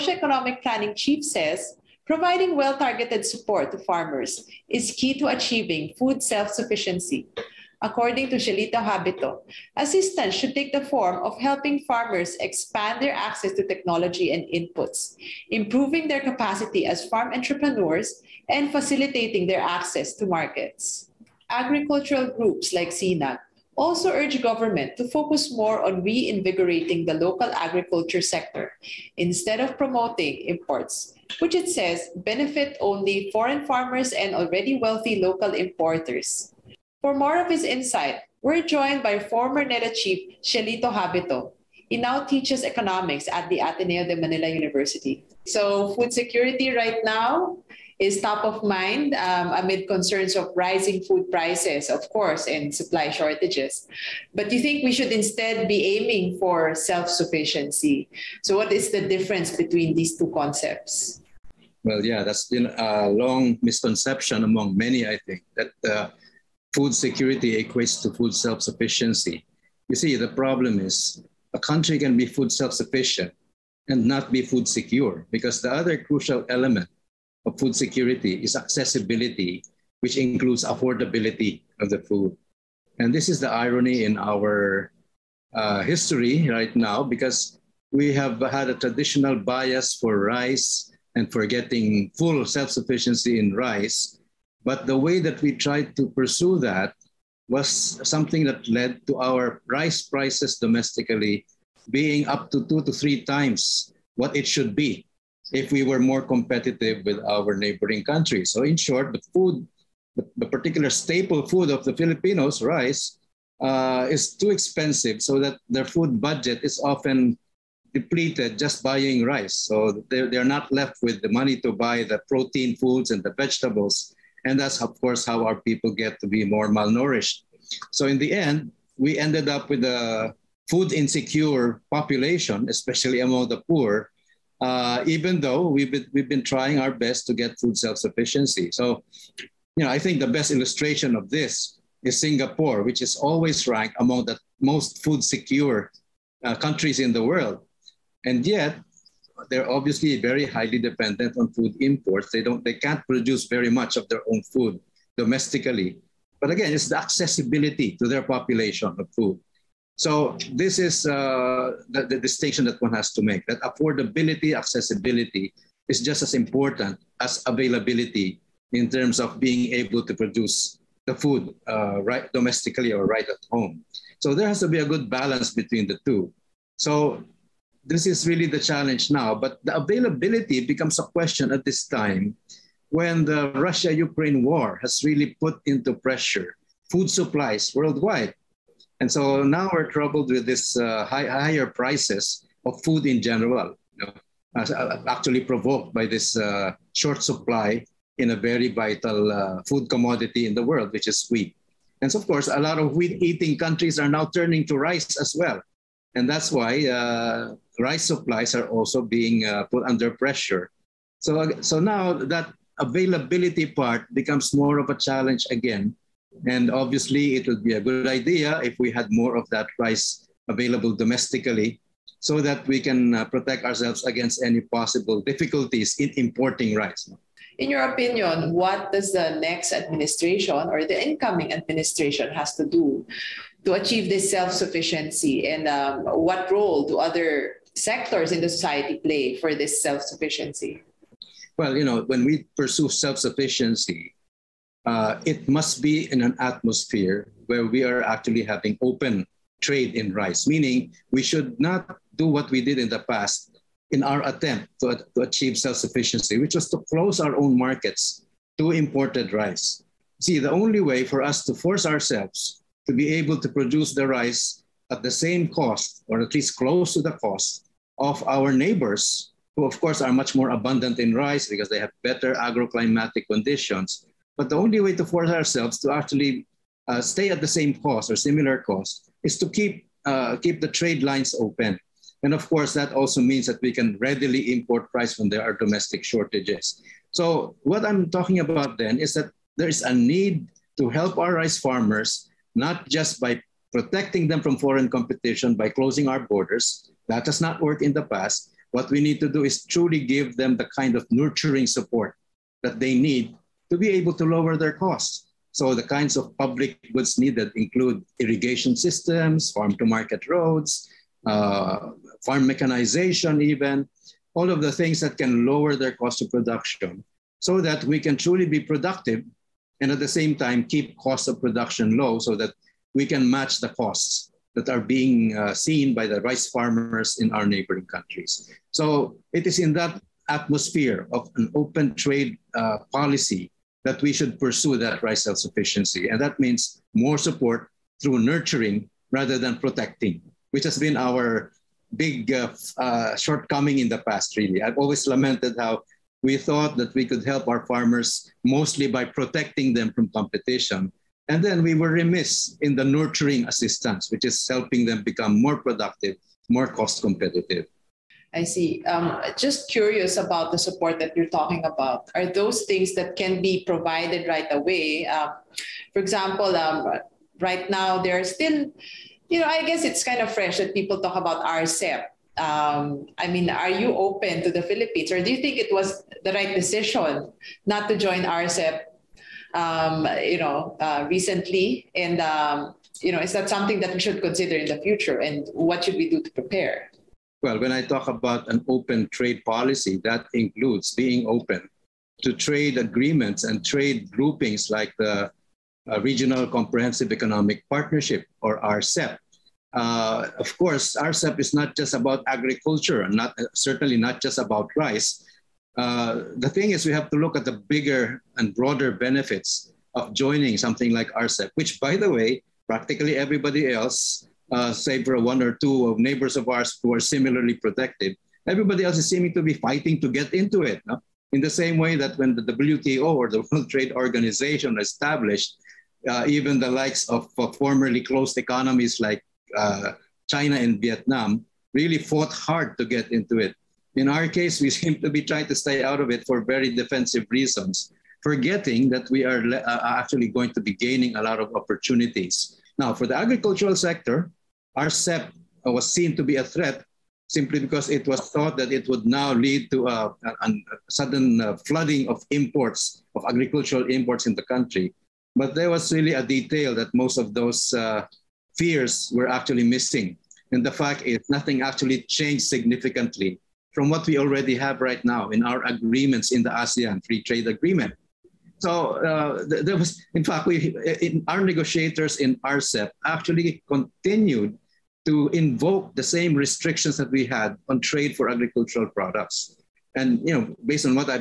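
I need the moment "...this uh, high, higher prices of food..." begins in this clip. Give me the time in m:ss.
3:10.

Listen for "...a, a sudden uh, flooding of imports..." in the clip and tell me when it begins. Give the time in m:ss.
7:30.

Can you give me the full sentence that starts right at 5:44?
I've always lamented how we thought that we could help our farmers mostly by protecting them from competition.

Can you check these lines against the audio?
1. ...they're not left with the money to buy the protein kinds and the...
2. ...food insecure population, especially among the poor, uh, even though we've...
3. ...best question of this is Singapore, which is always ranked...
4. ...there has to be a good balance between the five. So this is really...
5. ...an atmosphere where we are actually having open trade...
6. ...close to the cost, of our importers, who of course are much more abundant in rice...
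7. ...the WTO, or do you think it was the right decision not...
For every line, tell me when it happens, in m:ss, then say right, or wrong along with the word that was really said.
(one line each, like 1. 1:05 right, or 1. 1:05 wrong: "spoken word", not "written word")
1. 2:00 wrong: "foods", not "kinds"
2. 2:10 right
3. 2:20 wrong: "illustration", not "question"
4. 2:54 wrong: "two", not "five"
5. 4:06 right
6. 4:26 wrong: "neighbors", not "importers"
7. 6:14 wrong: "Philippines", not "WTO".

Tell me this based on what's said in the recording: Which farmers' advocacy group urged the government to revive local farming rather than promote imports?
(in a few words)
SINAG.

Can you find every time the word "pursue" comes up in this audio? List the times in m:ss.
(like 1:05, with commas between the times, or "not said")
1:36, 4:02, 5:34.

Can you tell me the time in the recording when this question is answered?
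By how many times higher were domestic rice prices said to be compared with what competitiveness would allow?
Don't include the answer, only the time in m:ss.
1:42.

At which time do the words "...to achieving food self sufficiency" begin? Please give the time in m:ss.
0:05.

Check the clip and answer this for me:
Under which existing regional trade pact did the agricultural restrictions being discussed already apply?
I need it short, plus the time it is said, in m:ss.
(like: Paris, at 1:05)
ASEAN Free Trade Agreement, at 7:46.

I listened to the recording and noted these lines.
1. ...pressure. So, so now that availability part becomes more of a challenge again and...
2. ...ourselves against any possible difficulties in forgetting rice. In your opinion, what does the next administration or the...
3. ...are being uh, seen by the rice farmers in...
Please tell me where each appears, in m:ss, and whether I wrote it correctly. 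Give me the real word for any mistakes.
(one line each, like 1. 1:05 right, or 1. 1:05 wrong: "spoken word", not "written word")
1. 3:30 right
2. 3:43 wrong: "importing", not "forgetting"
3. 5:24 right.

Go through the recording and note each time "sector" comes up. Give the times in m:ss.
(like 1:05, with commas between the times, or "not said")
0:28, 3:57, 7:23.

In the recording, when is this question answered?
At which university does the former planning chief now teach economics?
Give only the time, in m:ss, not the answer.
0:43.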